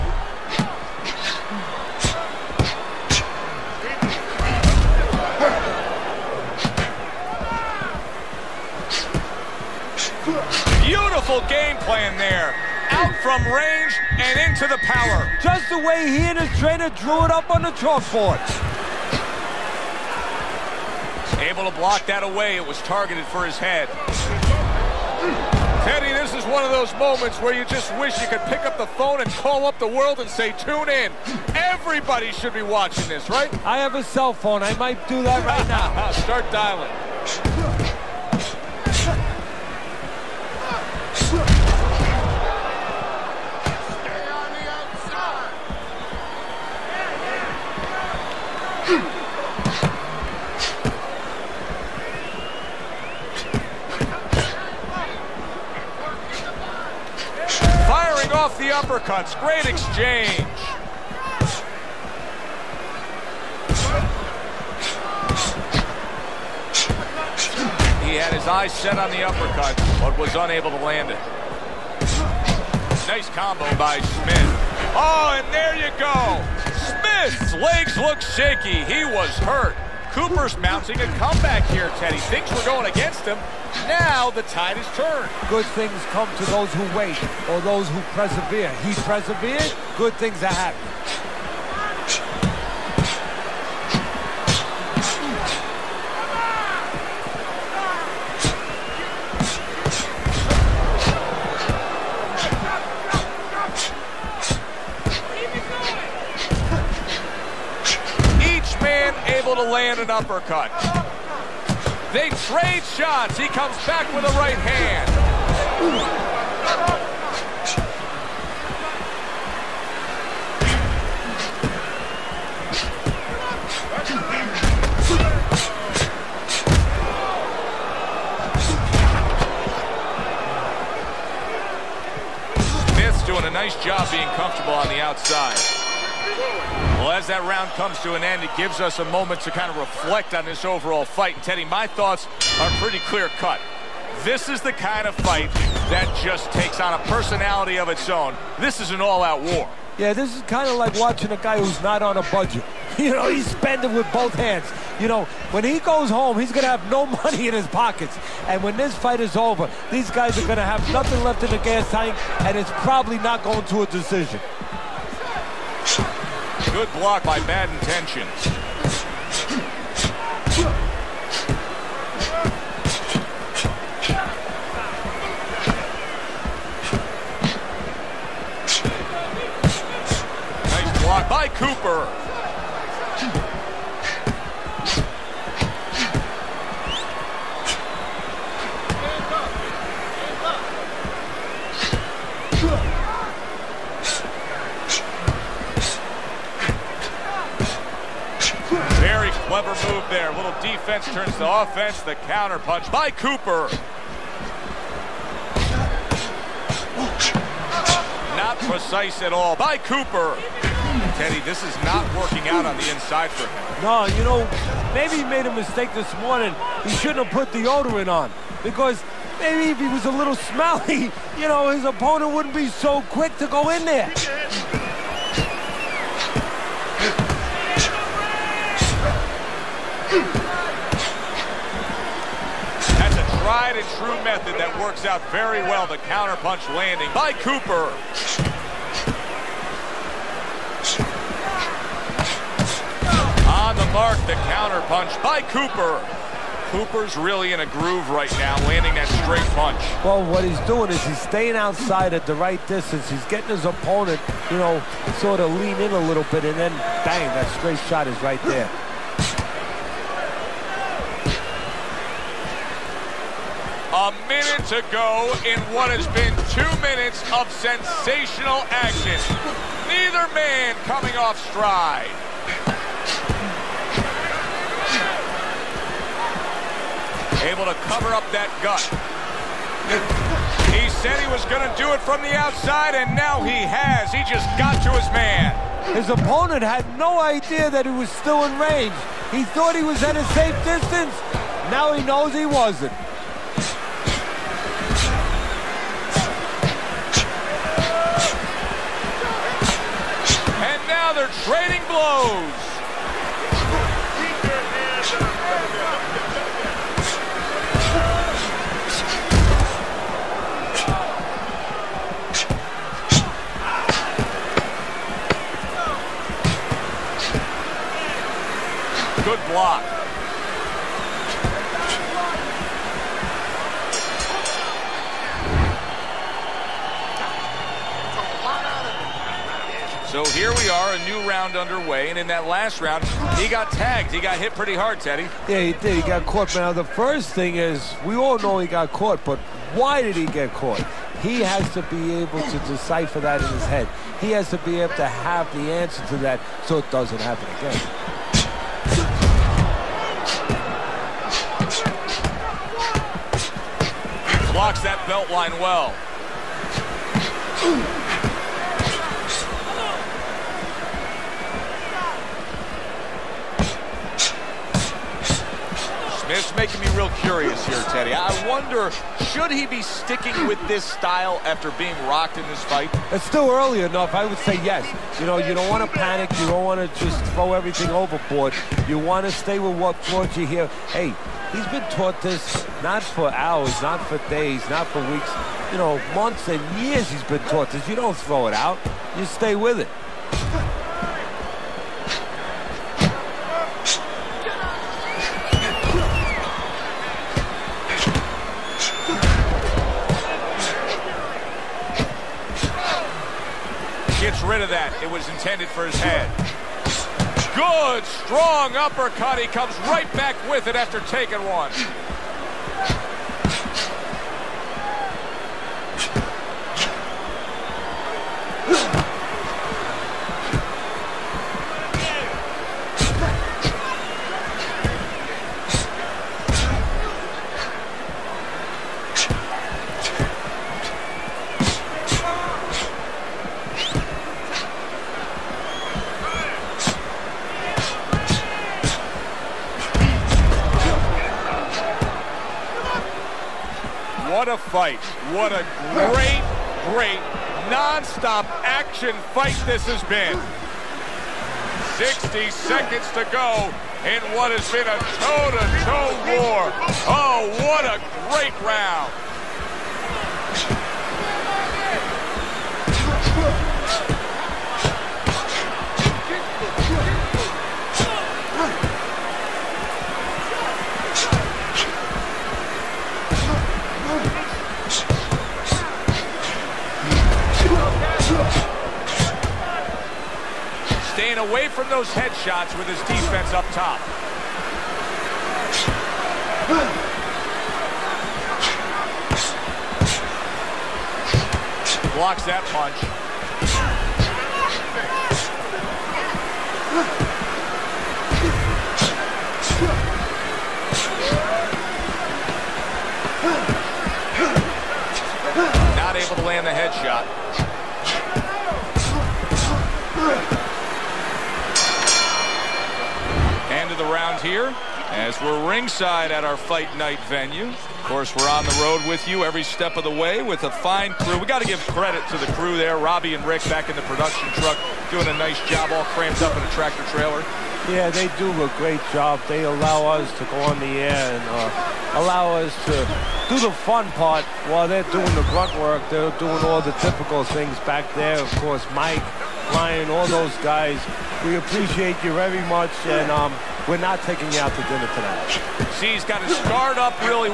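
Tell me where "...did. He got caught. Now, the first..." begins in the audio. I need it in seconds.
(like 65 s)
335 s.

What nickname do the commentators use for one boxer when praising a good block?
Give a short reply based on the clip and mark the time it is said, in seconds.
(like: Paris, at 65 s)
Bad Intentions, at 167 s.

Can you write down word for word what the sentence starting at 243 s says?
On the mark, the counterpunch by Cooper.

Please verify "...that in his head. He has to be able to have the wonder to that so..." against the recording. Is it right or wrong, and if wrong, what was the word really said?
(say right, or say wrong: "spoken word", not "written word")
wrong: "answer", not "wonder".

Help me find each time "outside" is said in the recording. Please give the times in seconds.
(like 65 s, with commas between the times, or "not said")
135 s, 251 s, 282 s.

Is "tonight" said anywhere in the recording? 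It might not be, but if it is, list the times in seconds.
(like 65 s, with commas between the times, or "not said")
545 s.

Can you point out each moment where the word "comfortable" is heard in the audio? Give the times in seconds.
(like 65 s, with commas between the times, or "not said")
134 s.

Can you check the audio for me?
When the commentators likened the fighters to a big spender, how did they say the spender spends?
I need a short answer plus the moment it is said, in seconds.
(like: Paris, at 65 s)
Both hands, at 154 s.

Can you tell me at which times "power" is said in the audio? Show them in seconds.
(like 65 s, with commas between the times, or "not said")
14 s.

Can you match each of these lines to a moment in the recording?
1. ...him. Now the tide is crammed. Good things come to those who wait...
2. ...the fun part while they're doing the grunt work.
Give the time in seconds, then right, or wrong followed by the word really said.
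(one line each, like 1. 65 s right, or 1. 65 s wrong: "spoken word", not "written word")
1. 83 s wrong: "turned", not "crammed"
2. 533 s right.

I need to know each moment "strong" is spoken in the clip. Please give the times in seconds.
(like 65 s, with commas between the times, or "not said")
408 s.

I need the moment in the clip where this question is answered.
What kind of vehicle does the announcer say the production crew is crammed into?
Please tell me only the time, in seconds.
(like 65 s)
526 s.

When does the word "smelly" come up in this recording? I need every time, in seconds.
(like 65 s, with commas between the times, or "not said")
220 s.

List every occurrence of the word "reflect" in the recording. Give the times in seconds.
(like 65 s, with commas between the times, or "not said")
139 s.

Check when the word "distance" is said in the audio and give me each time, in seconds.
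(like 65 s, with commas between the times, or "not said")
252 s, 290 s.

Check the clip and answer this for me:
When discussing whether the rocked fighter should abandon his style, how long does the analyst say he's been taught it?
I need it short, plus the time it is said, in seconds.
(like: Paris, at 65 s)
Months and years, at 386 s.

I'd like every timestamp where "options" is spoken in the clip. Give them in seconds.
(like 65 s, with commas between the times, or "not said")
not said.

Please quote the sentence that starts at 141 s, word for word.
And Teddy, my thoughts are pretty clear cut.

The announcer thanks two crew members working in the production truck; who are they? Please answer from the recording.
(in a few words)
Robbie and Rick.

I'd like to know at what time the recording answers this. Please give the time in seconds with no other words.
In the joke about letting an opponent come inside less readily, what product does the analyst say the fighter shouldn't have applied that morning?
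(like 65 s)
217 s.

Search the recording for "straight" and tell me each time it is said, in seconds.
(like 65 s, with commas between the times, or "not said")
249 s, 257 s.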